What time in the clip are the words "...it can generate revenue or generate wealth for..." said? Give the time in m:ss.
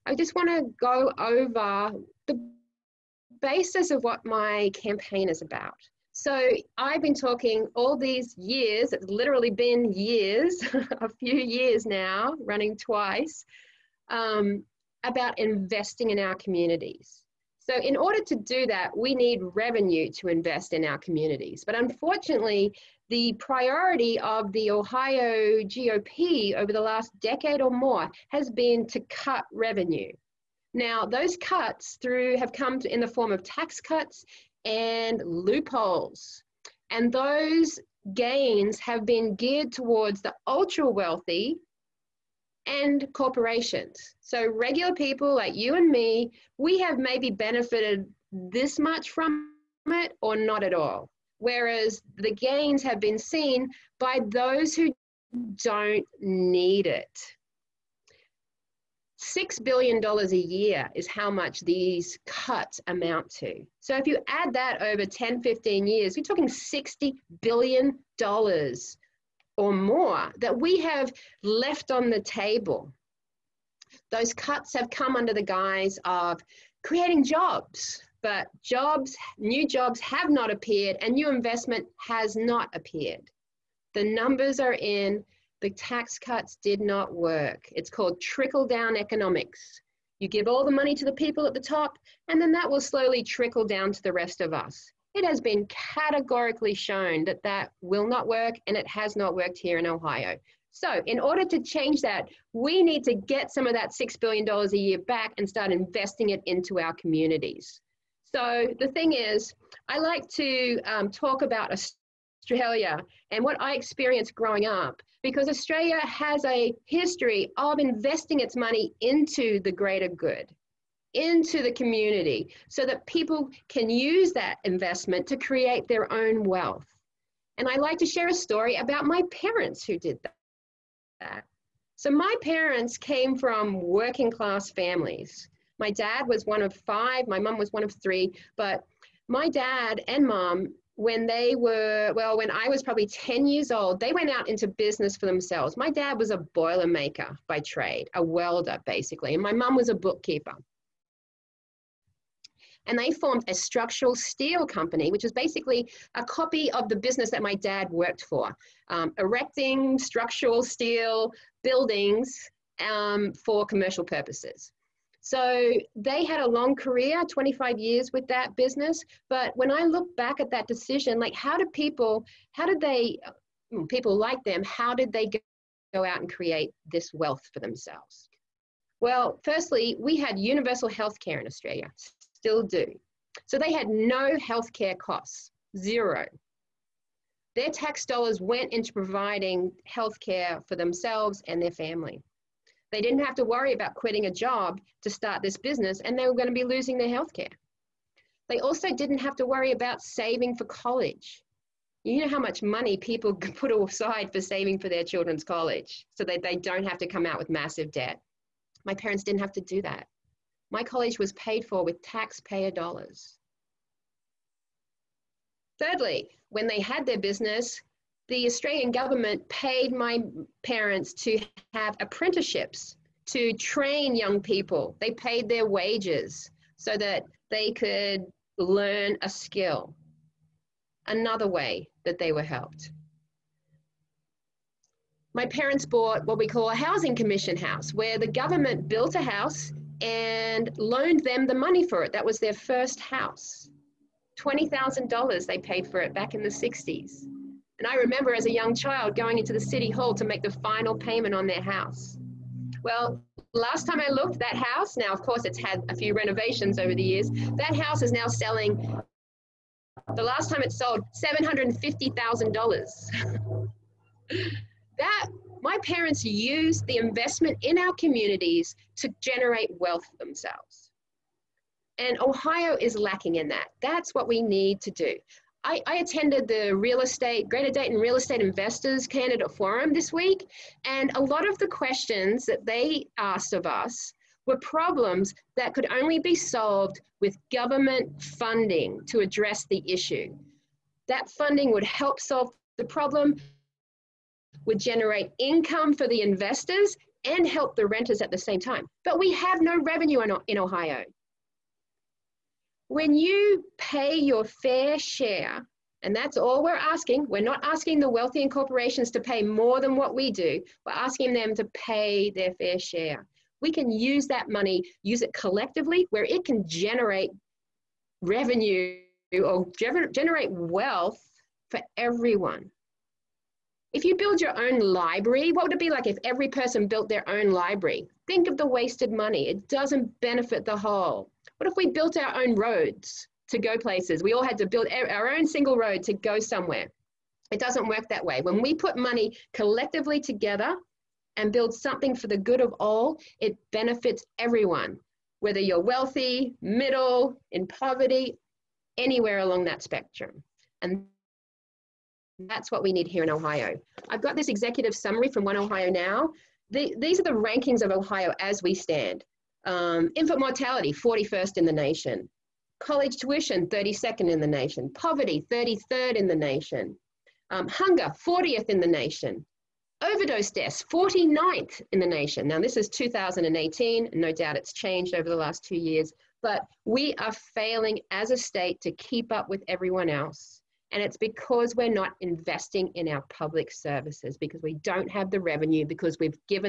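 5:16.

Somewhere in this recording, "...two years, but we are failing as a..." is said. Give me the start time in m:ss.
6:15.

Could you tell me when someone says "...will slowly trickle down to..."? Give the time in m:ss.
1:32.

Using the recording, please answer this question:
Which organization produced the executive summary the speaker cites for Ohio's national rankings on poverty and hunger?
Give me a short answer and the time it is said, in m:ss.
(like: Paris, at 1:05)
One Ohio Now, at 5:55.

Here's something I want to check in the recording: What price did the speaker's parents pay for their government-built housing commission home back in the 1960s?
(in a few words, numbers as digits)
$20,000.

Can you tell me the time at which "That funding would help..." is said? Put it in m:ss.
4:51.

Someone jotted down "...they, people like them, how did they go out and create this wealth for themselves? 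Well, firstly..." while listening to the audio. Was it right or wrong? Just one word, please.
right.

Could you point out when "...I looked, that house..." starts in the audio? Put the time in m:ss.
4:13.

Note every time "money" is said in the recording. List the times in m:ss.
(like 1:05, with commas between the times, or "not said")
1:30, 1:58, 3:22, 4:01, 5:14, 5:29, 5:38.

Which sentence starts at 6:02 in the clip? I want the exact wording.
College tuition, 32nd in the nation.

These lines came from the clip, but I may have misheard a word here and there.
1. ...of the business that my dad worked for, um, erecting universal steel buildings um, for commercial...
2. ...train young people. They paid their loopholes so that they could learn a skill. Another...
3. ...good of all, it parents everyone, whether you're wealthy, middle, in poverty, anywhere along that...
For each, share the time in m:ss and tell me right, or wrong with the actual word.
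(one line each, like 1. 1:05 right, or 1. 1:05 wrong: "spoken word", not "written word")
1. 2:36 wrong: "structural", not "universal"
2. 3:43 wrong: "wages", not "loopholes"
3. 5:42 wrong: "benefits", not "parents".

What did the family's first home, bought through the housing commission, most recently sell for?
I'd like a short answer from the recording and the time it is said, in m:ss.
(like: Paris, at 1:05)
$750,000, at 4:21.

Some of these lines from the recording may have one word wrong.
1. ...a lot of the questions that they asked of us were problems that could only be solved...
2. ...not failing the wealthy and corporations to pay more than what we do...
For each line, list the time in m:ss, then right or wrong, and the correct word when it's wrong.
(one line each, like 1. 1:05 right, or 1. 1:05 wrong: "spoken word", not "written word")
1. 4:41 right
2. 5:07 wrong: "asking", not "failing".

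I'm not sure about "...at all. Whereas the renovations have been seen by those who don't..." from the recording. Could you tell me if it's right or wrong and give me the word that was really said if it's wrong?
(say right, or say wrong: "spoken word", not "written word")
wrong: "gains", not "renovations".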